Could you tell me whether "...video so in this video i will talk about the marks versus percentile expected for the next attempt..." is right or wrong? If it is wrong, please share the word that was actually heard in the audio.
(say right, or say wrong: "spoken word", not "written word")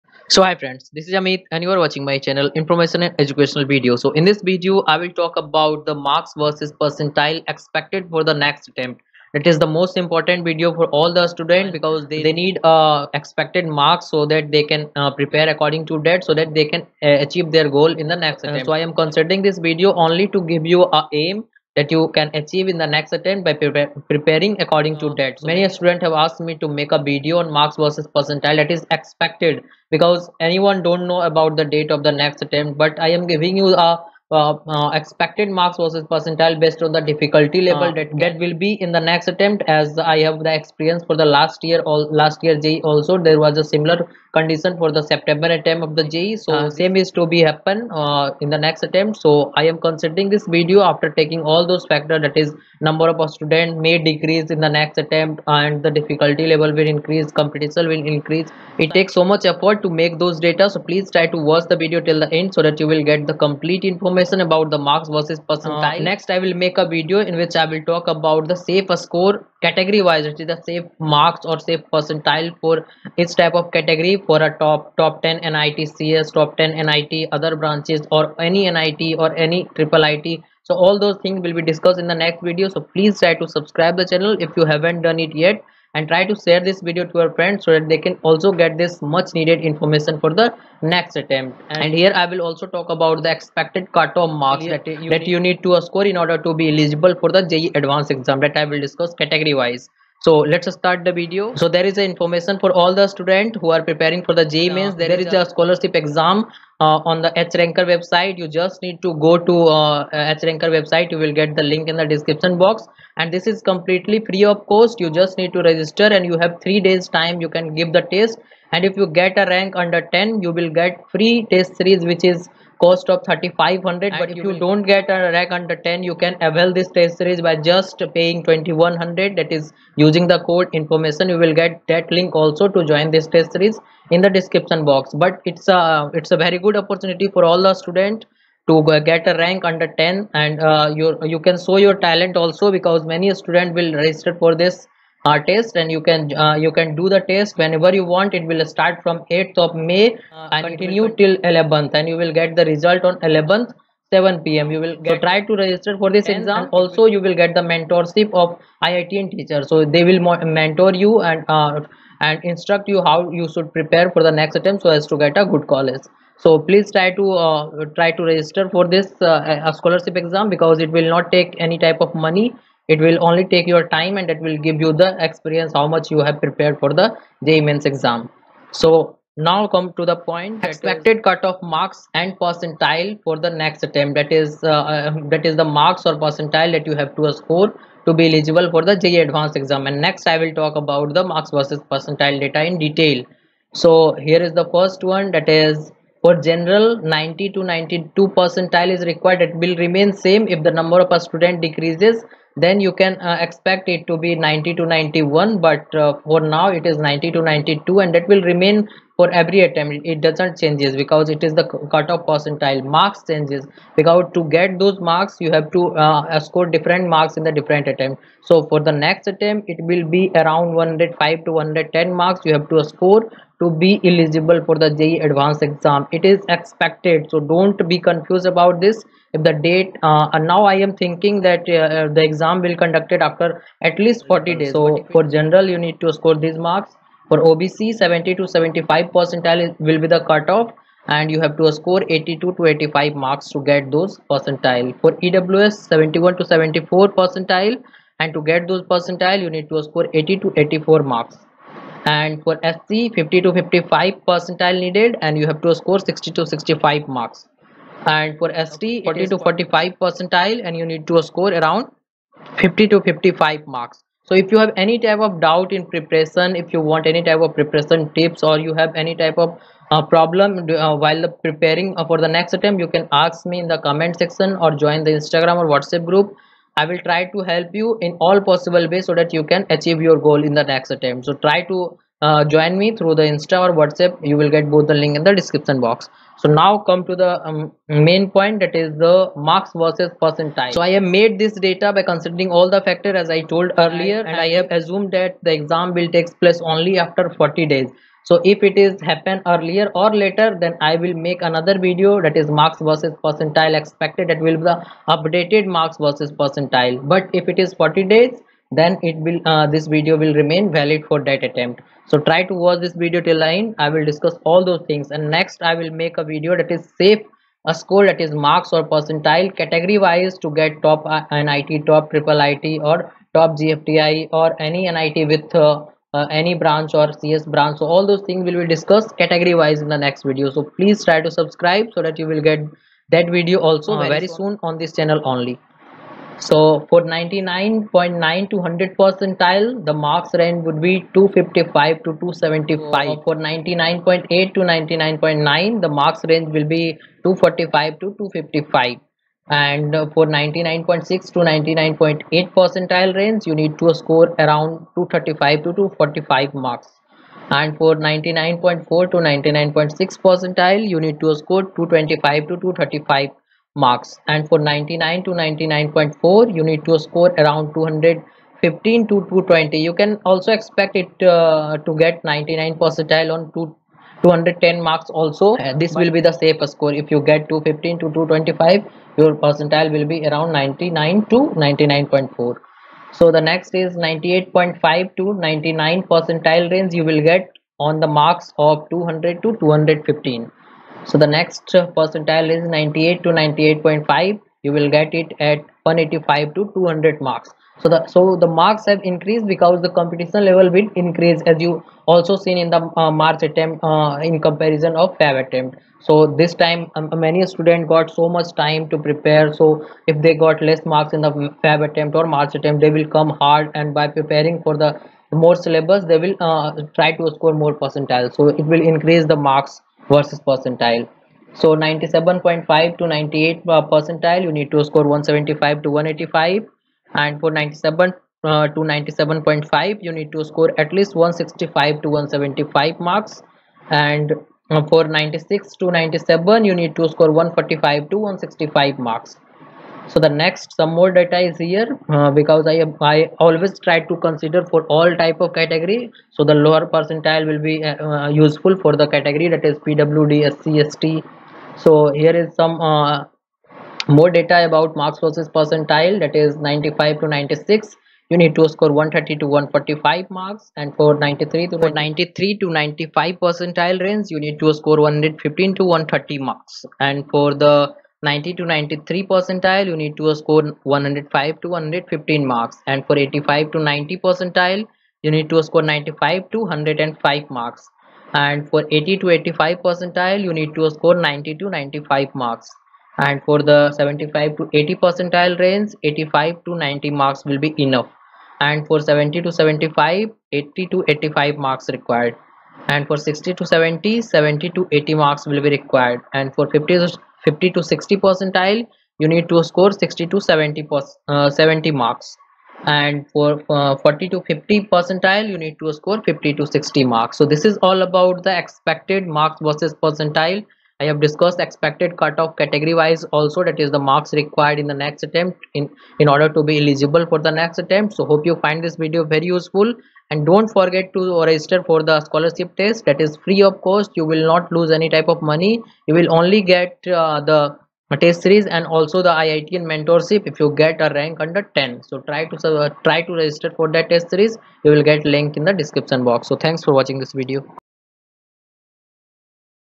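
right.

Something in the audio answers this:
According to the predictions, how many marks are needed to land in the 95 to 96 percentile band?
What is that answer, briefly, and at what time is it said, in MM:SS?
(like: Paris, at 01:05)
130 to 145, at 07:38.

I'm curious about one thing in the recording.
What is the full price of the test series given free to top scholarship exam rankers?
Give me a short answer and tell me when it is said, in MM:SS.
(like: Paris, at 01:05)
3500, at 02:03.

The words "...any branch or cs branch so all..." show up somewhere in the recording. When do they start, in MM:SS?
05:26.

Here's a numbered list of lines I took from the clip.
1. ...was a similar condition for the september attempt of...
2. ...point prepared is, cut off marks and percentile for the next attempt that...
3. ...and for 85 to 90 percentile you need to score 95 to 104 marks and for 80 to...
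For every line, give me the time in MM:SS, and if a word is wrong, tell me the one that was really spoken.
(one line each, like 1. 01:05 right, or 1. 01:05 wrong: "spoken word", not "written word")
1. 00:43 right
2. 03:00 wrong: "expected", not "prepared"
3. 07:52 wrong: "105", not "104".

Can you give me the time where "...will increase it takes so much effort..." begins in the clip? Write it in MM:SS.
00:57.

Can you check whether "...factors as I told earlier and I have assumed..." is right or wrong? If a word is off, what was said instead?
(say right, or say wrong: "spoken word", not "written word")
right.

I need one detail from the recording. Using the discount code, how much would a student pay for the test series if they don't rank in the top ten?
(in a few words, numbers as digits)
2100.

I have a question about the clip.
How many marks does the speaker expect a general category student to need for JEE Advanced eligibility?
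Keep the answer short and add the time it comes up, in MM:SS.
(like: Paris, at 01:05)
105 to 110, at 03:40.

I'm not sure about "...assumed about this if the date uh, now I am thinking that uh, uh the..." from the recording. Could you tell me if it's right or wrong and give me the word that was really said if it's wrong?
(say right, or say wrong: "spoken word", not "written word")
wrong: "confused", not "assumed".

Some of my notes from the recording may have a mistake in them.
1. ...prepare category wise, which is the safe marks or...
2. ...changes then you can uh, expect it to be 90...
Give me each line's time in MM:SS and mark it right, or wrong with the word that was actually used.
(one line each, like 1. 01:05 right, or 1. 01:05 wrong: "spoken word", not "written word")
1. 01:08 wrong: "score", not "prepare"
2. 03:21 wrong: "decreases", not "changes".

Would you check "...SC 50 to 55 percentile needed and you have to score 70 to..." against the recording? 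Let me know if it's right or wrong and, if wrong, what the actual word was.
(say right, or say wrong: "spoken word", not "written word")
wrong: "60", not "70".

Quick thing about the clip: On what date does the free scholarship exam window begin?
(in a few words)
8th of May.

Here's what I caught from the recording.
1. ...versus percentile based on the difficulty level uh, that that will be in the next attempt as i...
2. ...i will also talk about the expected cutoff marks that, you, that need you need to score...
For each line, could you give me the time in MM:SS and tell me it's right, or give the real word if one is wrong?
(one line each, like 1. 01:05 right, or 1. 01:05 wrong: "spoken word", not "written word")
1. 00:35 right
2. 01:32 right.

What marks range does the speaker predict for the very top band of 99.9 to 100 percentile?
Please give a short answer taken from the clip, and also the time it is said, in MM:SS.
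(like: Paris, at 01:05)
255 to 275, at 05:41.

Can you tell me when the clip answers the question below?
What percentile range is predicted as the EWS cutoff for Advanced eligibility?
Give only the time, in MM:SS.
04:05.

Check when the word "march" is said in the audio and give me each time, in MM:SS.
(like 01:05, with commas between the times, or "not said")
06:43, 06:52.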